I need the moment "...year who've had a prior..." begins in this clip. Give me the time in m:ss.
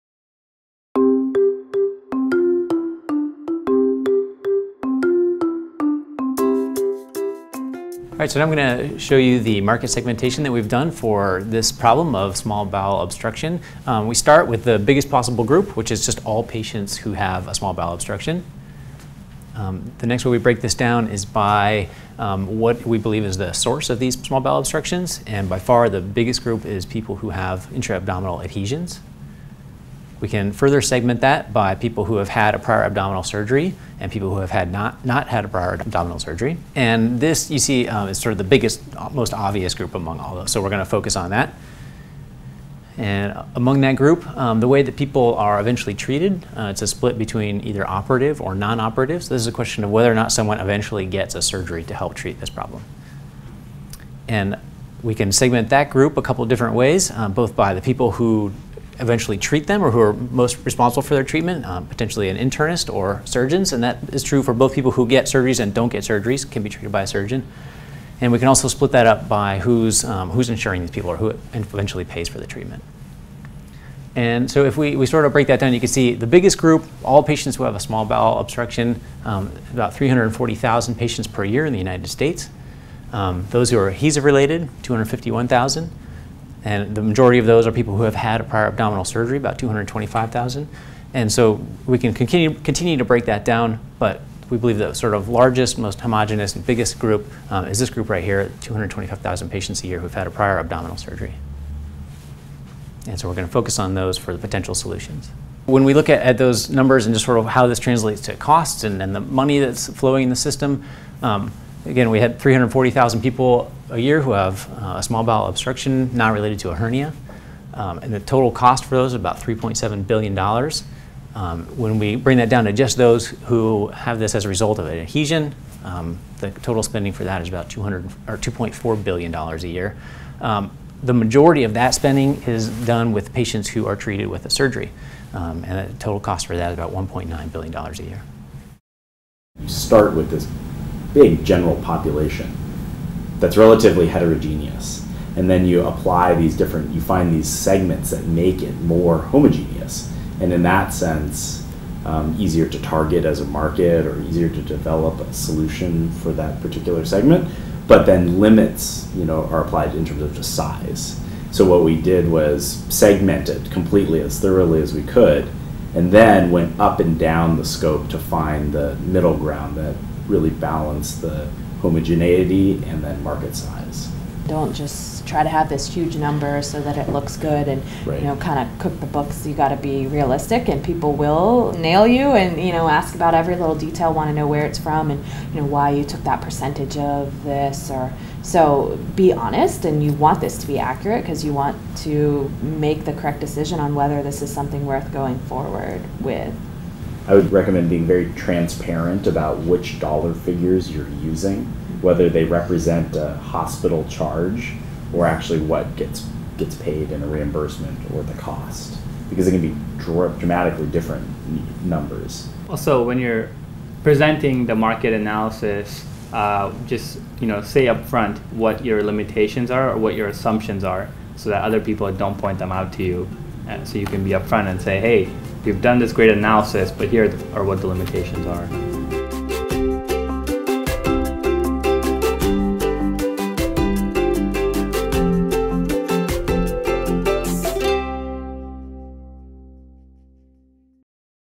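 1:39.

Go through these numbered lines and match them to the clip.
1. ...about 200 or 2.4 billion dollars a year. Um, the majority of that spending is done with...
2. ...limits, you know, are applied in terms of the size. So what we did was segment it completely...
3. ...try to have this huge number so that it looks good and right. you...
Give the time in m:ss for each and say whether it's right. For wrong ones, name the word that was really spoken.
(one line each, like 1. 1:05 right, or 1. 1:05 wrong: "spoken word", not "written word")
1. 2:07 right
2. 2:38 right
3. 2:55 right.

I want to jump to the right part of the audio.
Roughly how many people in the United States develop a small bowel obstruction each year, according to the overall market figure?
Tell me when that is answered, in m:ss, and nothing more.
1:19.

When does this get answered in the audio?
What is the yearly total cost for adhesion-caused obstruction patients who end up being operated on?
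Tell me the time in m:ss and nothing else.
2:16.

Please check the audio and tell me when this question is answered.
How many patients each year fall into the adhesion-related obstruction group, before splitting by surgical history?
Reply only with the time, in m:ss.
1:24.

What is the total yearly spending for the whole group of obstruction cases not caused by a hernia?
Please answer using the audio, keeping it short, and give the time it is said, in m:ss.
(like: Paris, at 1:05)
$3.7 billion, at 1:59.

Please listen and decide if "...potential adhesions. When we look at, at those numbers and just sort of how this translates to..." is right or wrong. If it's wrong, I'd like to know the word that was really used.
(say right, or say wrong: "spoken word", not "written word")
wrong: "solutions", not "adhesions".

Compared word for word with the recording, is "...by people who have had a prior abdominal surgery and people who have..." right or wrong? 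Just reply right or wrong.
right.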